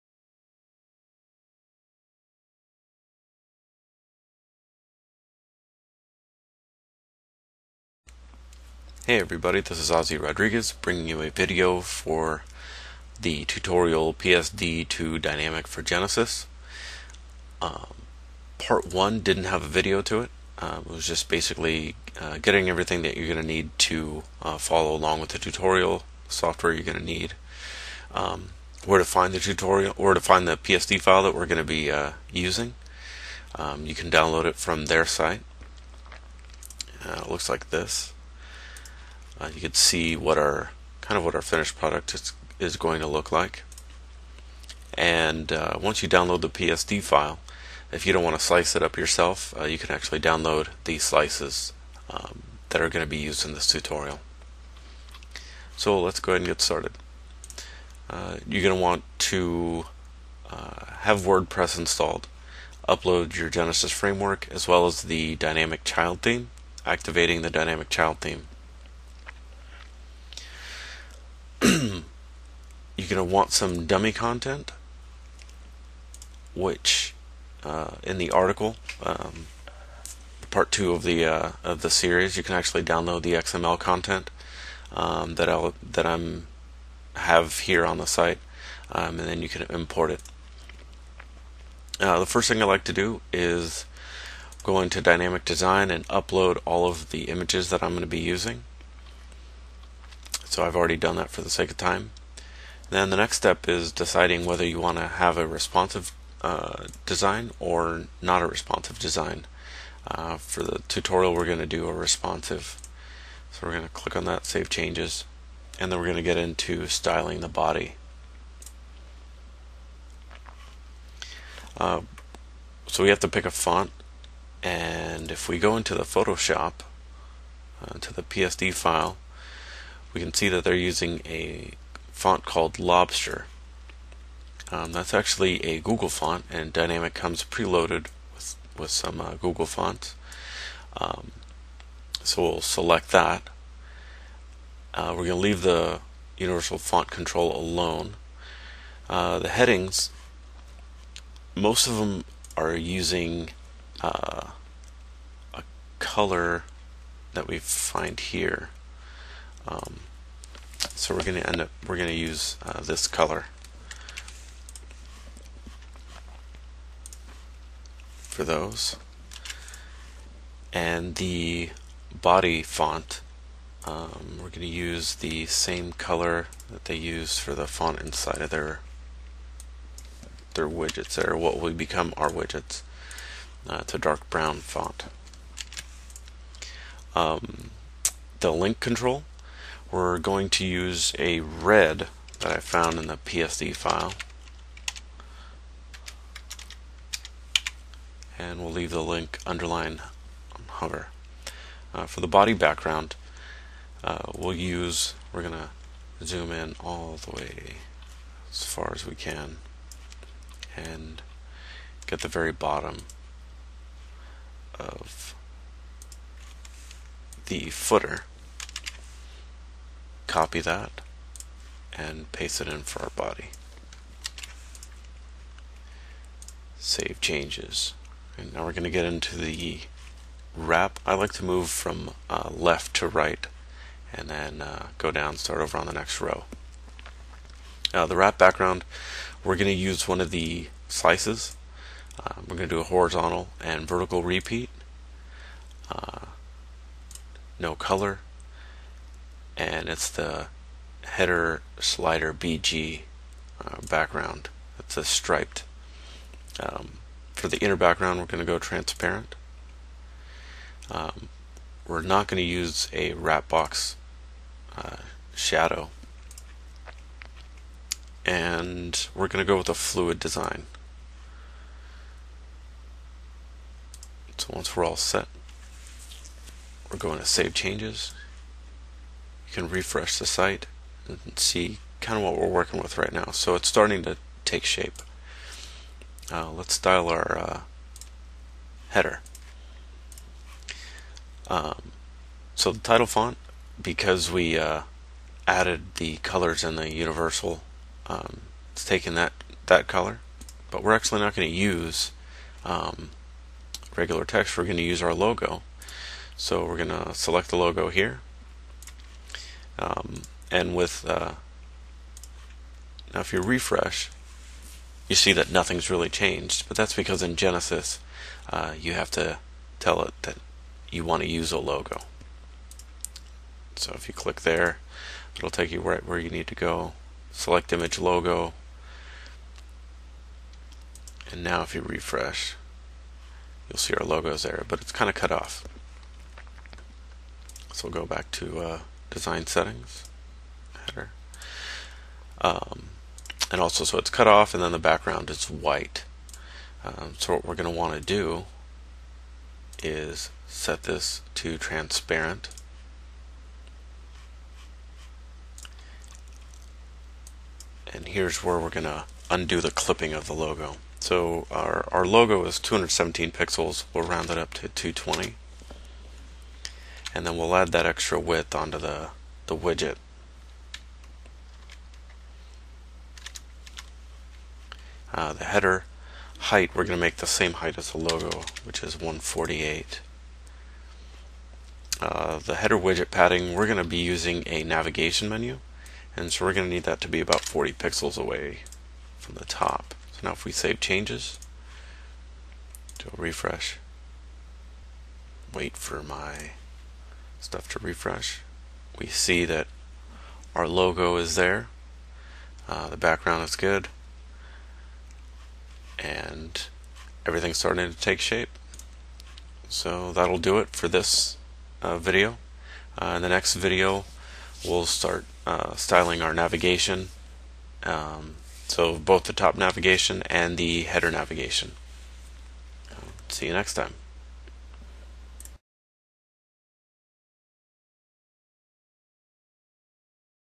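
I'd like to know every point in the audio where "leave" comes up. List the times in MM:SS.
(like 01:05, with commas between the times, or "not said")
02:25, 03:18.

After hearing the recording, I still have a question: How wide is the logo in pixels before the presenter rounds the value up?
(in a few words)
217.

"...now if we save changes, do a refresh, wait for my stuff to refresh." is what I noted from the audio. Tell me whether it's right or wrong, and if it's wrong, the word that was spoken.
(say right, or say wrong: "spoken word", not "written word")
right.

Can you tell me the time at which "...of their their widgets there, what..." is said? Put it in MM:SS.
02:58.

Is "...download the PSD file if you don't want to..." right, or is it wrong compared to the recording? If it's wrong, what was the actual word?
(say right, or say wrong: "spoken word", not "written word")
right.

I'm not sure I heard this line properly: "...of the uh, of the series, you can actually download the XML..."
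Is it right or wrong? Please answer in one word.
right.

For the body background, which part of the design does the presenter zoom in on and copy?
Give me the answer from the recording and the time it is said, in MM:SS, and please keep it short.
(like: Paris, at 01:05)
the very bottom of the footer, at 03:32.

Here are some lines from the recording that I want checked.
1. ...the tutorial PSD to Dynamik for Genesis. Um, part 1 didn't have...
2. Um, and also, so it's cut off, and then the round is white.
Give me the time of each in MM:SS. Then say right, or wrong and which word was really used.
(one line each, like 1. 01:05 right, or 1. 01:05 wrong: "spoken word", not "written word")
1. 00:13 right
2. 05:42 wrong: "background", not "round".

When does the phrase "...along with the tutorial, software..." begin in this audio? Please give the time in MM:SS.
00:24.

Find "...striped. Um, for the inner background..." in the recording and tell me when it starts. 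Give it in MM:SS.
04:15.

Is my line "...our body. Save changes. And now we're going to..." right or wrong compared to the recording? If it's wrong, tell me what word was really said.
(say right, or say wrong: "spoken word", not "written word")
right.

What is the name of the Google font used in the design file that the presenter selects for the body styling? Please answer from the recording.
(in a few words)
Lobster.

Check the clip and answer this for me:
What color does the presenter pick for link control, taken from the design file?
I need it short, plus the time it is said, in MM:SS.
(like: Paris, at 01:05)
red, at 03:11.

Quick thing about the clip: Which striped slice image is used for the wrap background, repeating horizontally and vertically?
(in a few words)
header slider BG.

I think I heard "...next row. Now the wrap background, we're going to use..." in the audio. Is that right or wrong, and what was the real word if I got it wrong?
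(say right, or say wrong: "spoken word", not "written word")
right.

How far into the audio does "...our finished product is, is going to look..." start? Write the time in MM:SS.
00:41.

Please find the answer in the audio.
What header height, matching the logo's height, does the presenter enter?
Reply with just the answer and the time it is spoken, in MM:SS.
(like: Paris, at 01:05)
148, at 06:18.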